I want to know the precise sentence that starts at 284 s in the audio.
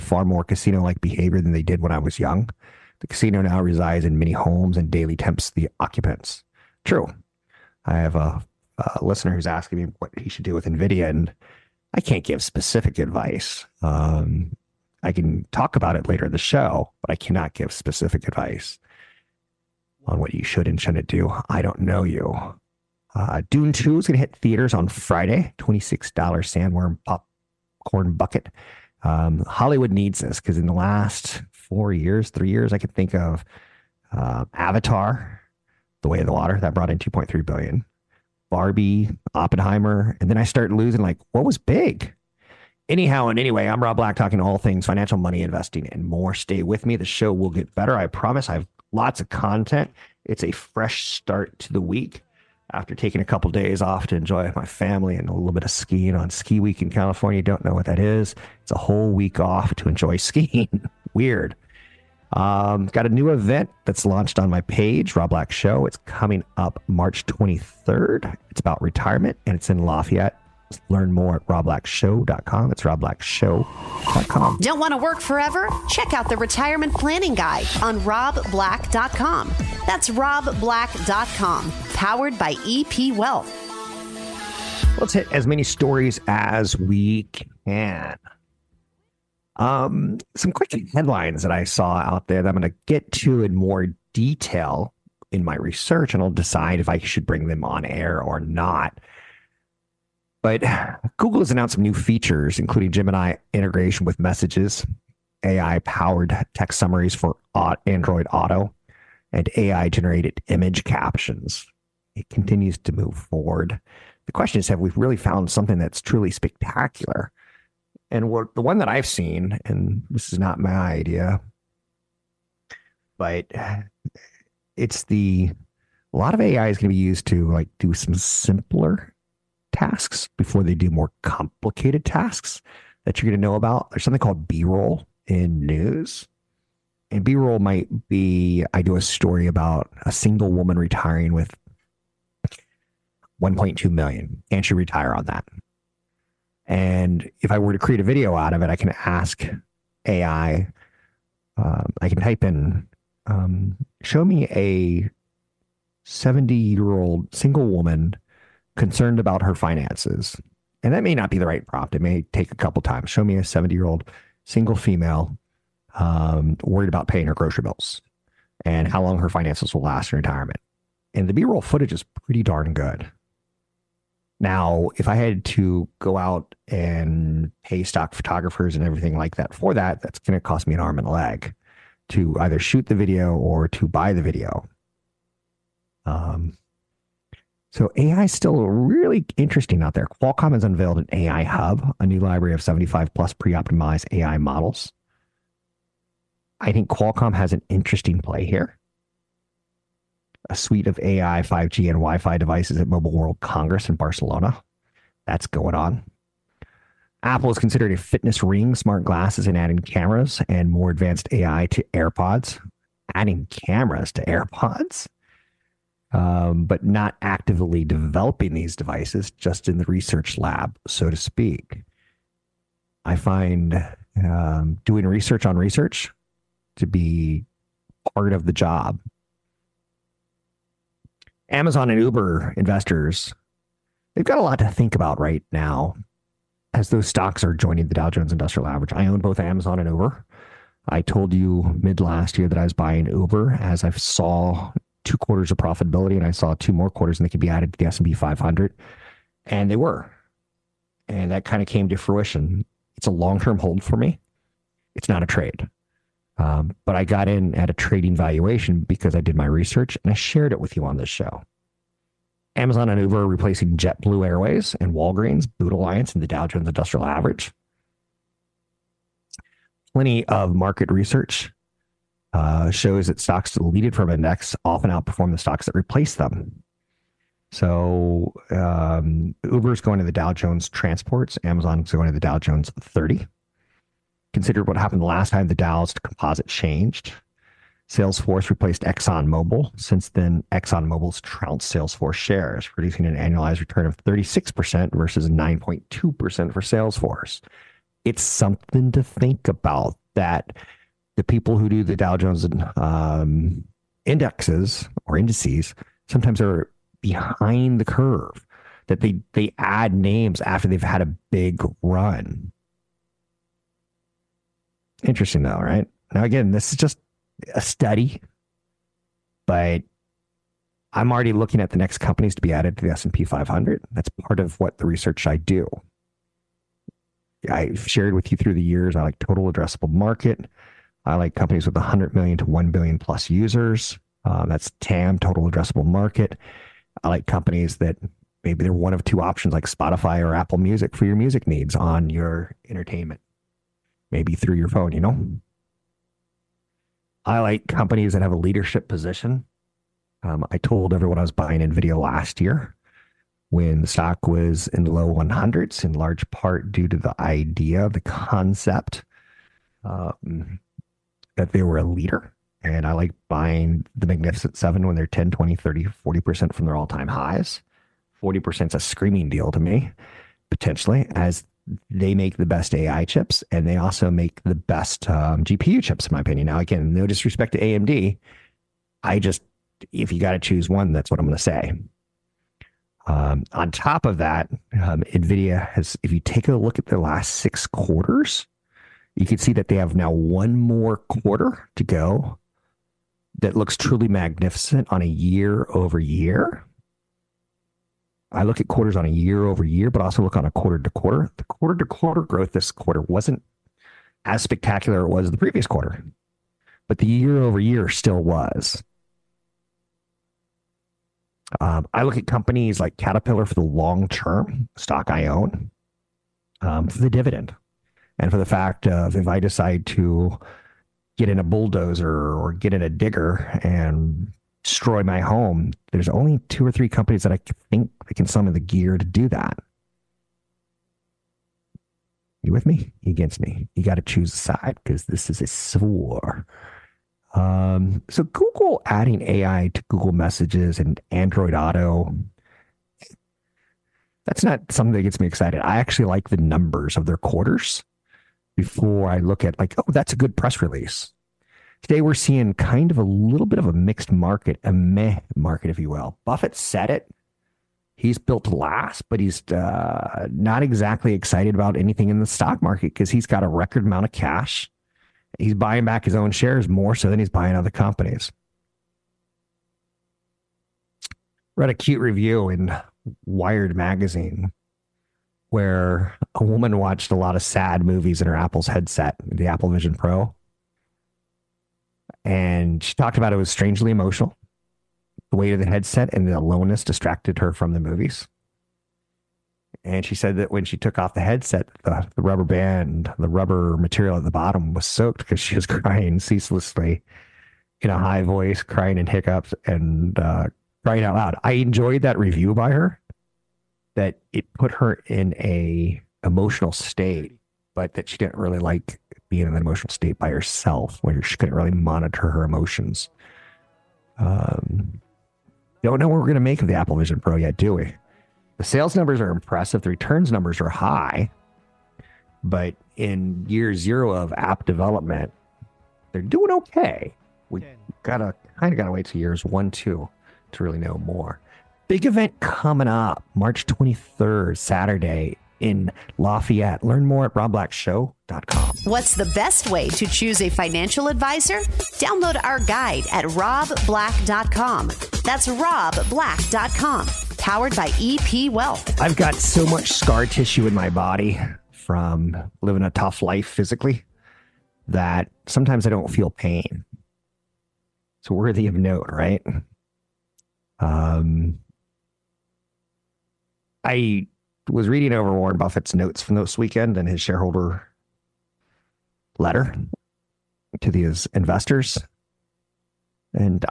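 Consider what happened the last time the Dow's composite changed.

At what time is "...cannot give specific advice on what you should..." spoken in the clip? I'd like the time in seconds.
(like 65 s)
17 s.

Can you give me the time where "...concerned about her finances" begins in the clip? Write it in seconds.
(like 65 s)
158 s.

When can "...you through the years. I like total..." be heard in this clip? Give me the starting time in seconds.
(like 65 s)
328 s.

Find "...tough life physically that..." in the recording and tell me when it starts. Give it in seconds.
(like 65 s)
552 s.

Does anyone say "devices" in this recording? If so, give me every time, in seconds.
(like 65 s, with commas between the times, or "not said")
202 s, 218 s.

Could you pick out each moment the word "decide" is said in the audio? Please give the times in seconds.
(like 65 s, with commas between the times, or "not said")
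96 s, 419 s.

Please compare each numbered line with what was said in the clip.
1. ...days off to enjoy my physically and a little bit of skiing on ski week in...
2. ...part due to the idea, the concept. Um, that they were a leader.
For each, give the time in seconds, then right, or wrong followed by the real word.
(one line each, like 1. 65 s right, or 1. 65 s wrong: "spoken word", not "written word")
1. 53 s wrong: "family", not "physically"
2. 356 s right.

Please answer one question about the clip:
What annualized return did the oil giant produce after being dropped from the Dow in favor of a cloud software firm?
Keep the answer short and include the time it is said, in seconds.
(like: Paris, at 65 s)
36%, at 294 s.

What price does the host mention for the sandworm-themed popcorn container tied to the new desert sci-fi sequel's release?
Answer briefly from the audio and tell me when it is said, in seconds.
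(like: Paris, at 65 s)
$26, at 25 s.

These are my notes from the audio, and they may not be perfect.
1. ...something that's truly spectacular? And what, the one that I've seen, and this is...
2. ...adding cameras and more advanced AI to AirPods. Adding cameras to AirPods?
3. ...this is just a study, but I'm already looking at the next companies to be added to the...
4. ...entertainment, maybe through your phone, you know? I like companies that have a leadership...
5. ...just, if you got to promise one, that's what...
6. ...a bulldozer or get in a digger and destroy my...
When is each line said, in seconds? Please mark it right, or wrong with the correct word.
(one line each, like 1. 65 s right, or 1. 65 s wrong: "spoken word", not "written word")
1. 115 s right
2. 209 s right
3. 316 s right
4. 342 s right
5. 379 s wrong: "choose", not "promise"
6. 421 s right.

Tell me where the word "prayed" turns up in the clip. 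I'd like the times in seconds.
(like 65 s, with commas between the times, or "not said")
not said.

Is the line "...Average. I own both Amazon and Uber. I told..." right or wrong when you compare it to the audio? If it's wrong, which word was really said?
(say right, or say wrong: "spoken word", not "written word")
right.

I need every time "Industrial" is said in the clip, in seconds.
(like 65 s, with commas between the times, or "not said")
238 s, 266 s.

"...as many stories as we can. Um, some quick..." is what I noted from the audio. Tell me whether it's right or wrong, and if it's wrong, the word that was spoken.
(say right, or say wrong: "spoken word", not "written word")
right.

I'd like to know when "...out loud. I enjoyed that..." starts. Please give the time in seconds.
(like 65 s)
501 s.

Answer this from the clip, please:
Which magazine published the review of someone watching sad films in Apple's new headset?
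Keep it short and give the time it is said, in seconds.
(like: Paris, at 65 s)
Wired, at 473 s.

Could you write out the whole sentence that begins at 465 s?
He's buying back his own shares more so than he's buying other companies.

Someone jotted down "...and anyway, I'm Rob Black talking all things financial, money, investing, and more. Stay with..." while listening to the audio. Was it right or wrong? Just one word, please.
right.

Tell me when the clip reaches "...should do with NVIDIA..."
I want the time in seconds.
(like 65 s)
10 s.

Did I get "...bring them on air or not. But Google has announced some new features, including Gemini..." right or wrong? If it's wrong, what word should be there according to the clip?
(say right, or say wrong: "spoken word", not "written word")
right.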